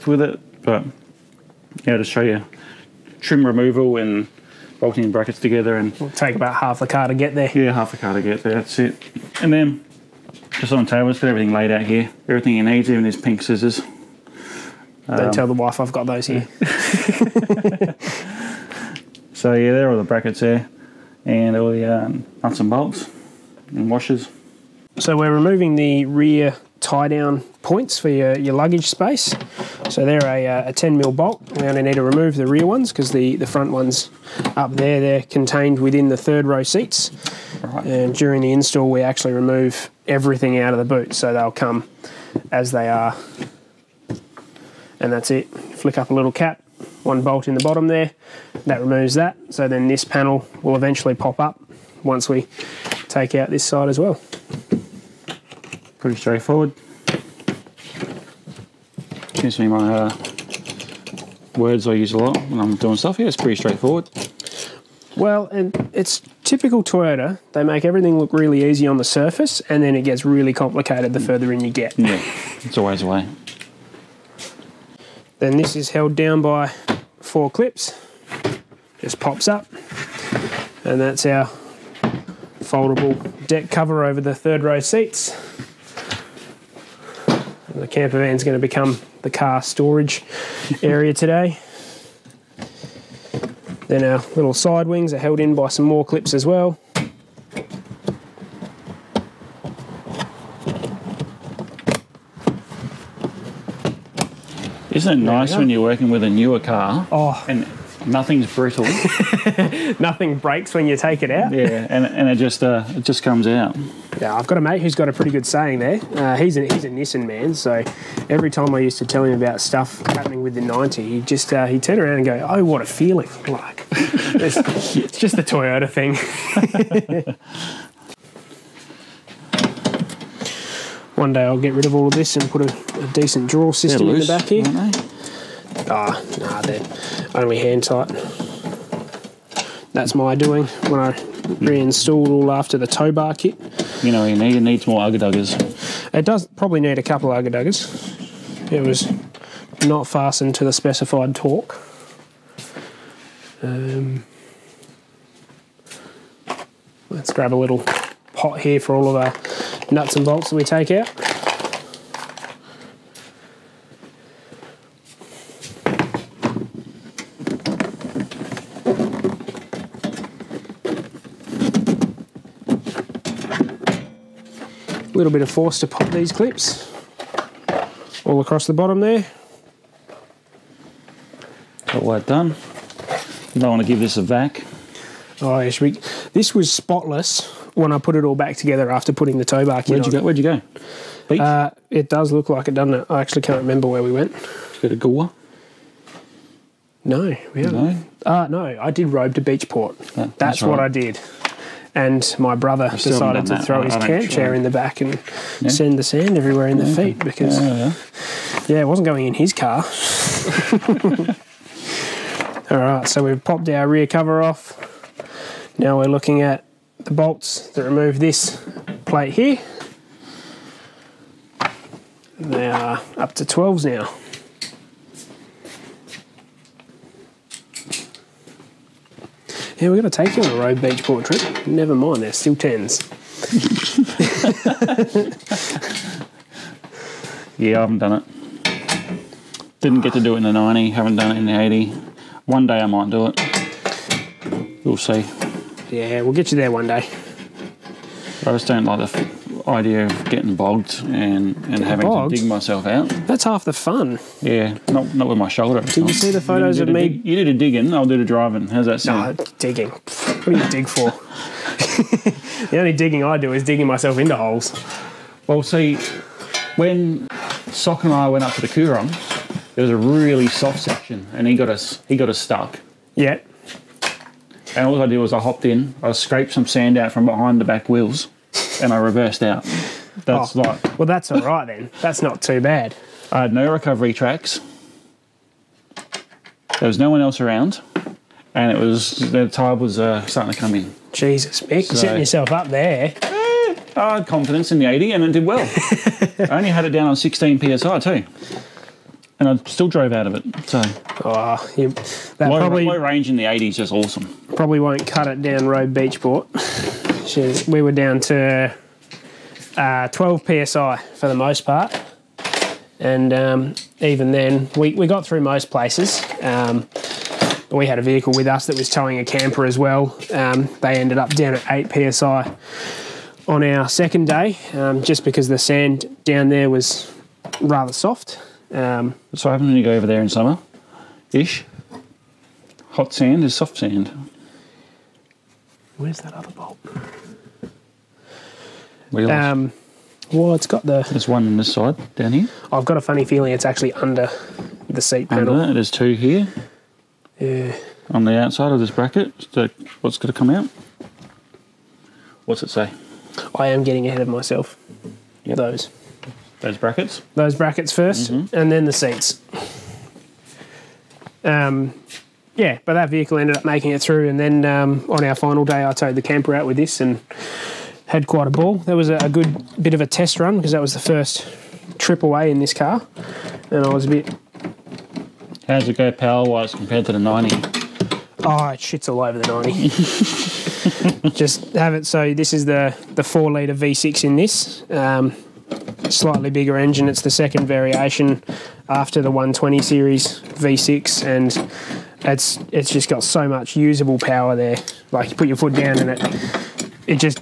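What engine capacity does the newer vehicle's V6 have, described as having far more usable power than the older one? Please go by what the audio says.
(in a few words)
4 litre.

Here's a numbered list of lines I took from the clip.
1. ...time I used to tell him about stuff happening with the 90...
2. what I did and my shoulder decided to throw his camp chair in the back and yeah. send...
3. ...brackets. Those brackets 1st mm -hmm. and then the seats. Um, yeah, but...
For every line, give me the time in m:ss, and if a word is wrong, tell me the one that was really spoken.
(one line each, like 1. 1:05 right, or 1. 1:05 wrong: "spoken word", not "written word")
1. 1:58 right
2. 3:20 wrong: "brother", not "shoulder"
3. 5:56 right.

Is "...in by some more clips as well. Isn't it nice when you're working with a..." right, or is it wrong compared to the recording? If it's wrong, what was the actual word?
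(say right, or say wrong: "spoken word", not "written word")
right.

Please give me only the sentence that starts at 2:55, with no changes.
little bit of force to pop these clips all across the bottom there.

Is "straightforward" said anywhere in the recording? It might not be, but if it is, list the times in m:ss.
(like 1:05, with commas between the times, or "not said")
0:56, 1:03.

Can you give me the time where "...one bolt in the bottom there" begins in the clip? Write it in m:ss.
0:47.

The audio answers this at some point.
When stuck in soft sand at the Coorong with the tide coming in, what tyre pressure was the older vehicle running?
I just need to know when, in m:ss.
4:57.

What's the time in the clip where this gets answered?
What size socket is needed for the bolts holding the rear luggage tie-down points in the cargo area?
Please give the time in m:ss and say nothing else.
0:30.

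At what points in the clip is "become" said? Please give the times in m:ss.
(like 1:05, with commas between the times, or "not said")
1:28.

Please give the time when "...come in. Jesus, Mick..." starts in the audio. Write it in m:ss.
4:50.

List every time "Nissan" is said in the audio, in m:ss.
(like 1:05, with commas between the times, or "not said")
1:56.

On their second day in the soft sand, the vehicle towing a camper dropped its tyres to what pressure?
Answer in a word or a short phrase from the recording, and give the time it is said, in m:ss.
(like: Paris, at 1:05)
8 psi, at 5:21.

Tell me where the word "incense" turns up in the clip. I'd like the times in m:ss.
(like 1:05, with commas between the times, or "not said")
not said.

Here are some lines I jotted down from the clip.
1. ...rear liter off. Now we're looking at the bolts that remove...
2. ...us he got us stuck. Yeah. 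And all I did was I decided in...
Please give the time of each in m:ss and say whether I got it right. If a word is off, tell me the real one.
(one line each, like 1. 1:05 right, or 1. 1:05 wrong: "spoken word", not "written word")
1. 3:33 wrong: "cover", not "liter"
2. 4:31 wrong: "hopped", not "decided".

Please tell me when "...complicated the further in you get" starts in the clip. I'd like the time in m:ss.
1:10.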